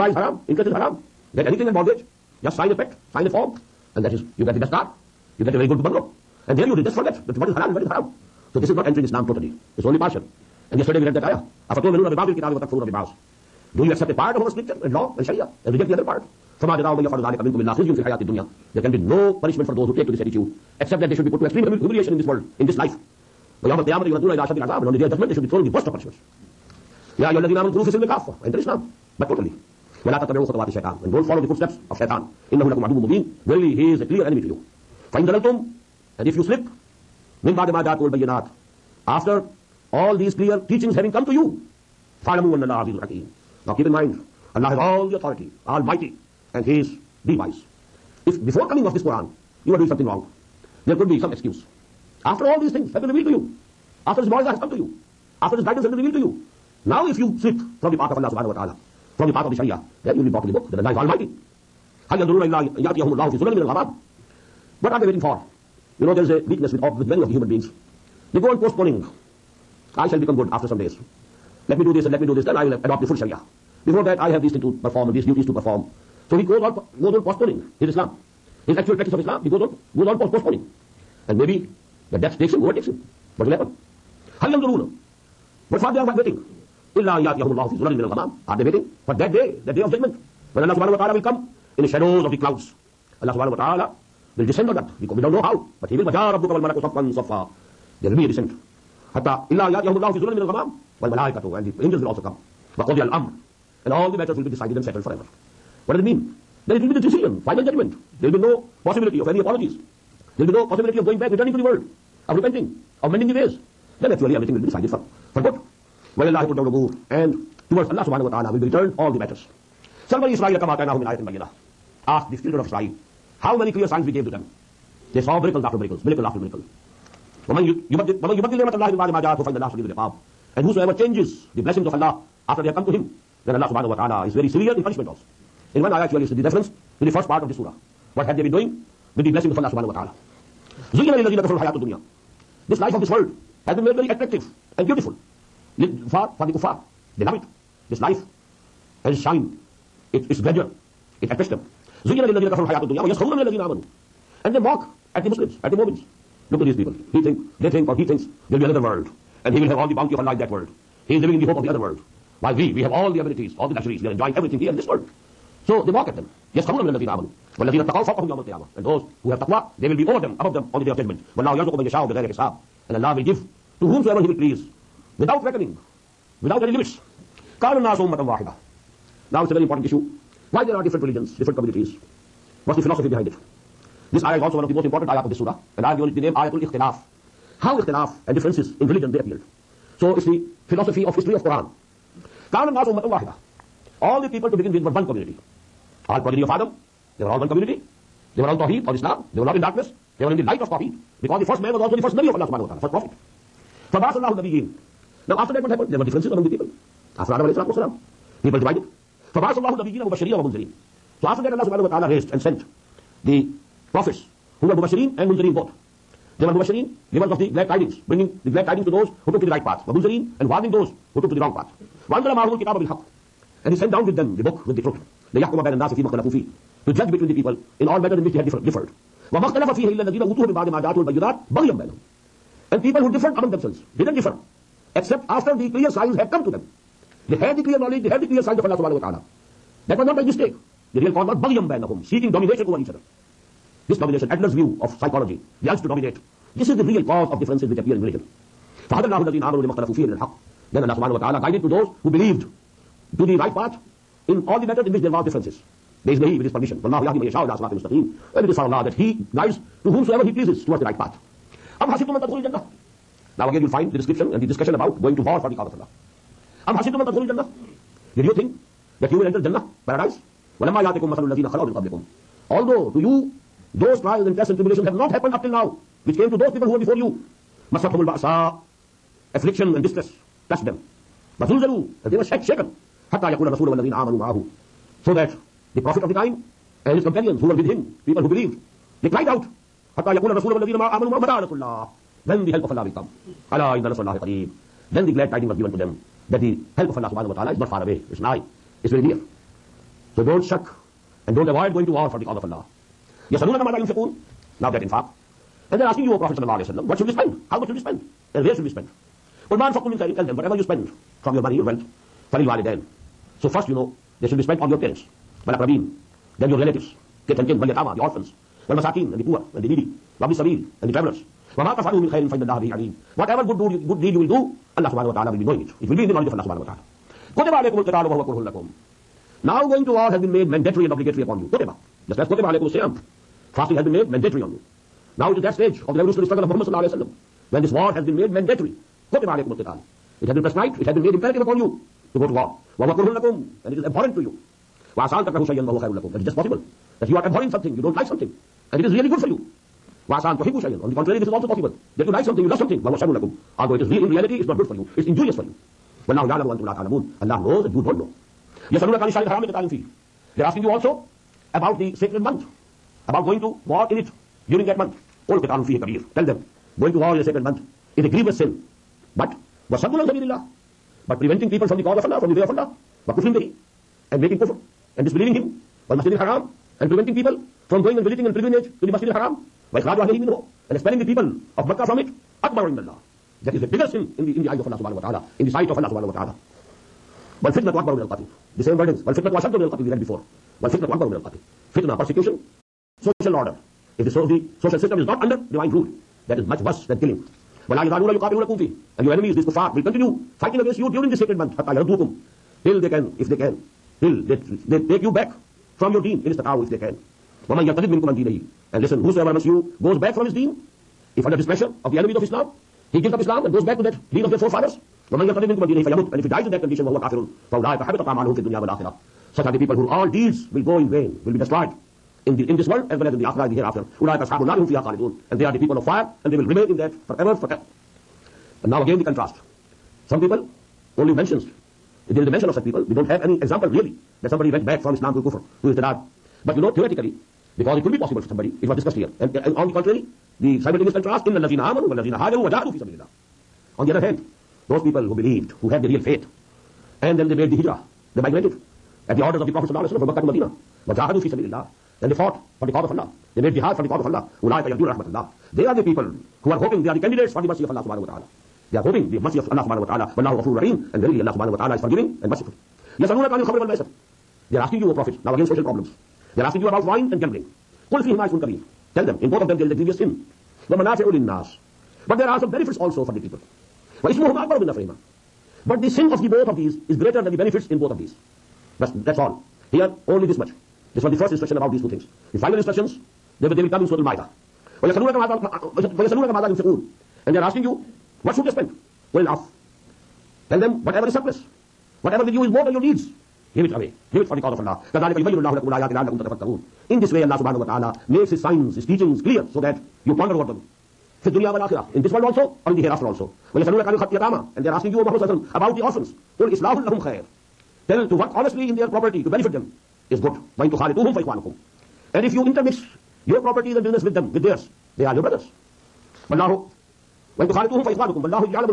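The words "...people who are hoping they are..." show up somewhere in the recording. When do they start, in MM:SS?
07:35.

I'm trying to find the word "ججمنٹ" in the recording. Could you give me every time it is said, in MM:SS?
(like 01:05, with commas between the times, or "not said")
01:47, 02:50.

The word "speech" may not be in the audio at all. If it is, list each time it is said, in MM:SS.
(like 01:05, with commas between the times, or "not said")
not said.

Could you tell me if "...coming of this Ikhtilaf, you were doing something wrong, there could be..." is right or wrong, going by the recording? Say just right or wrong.
wrong.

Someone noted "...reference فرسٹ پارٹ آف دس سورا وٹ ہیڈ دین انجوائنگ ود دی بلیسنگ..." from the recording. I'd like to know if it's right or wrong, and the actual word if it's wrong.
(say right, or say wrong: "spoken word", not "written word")
wrong: "ڈوئنگ", not "انجوائنگ".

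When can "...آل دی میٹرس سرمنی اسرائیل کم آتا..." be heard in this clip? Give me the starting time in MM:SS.
01:59.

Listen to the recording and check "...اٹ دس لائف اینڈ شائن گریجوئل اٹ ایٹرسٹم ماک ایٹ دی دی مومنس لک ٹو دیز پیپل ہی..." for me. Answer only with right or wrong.
right.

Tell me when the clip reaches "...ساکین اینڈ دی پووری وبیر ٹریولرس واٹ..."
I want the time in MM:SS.
05:18.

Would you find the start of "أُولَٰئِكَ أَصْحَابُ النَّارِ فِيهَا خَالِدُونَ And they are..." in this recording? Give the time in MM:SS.
07:03.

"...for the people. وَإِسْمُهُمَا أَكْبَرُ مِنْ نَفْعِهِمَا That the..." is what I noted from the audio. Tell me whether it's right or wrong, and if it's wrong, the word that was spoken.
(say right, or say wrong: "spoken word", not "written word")
wrong: "But", not "That".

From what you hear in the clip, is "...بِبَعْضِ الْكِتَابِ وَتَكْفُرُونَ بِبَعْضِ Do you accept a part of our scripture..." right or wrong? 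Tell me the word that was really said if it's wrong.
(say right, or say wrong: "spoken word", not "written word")
right.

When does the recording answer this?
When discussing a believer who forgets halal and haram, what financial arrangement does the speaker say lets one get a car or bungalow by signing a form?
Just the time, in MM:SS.
00:01.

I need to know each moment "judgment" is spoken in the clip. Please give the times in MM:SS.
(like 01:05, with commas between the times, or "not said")
00:25, 01:29.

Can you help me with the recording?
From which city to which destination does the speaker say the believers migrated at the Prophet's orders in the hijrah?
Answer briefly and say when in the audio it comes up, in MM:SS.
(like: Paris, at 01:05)
Mecca to Medina, at 07:29.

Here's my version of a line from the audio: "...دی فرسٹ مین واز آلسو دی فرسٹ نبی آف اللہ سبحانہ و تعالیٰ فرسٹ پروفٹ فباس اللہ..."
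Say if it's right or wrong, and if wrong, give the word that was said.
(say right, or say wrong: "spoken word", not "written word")
right.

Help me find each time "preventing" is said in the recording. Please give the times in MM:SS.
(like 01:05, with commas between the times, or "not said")
06:11, 06:16.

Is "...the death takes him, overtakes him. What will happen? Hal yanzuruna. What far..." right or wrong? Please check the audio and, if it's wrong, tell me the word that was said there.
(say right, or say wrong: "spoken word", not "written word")
right.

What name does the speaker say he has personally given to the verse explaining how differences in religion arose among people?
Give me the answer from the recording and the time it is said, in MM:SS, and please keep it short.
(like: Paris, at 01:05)
Ayatul Ikhtilaf, at 03:06.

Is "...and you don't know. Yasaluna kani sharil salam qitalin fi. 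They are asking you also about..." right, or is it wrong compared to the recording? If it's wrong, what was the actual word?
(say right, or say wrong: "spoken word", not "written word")
wrong: "haram", not "salam".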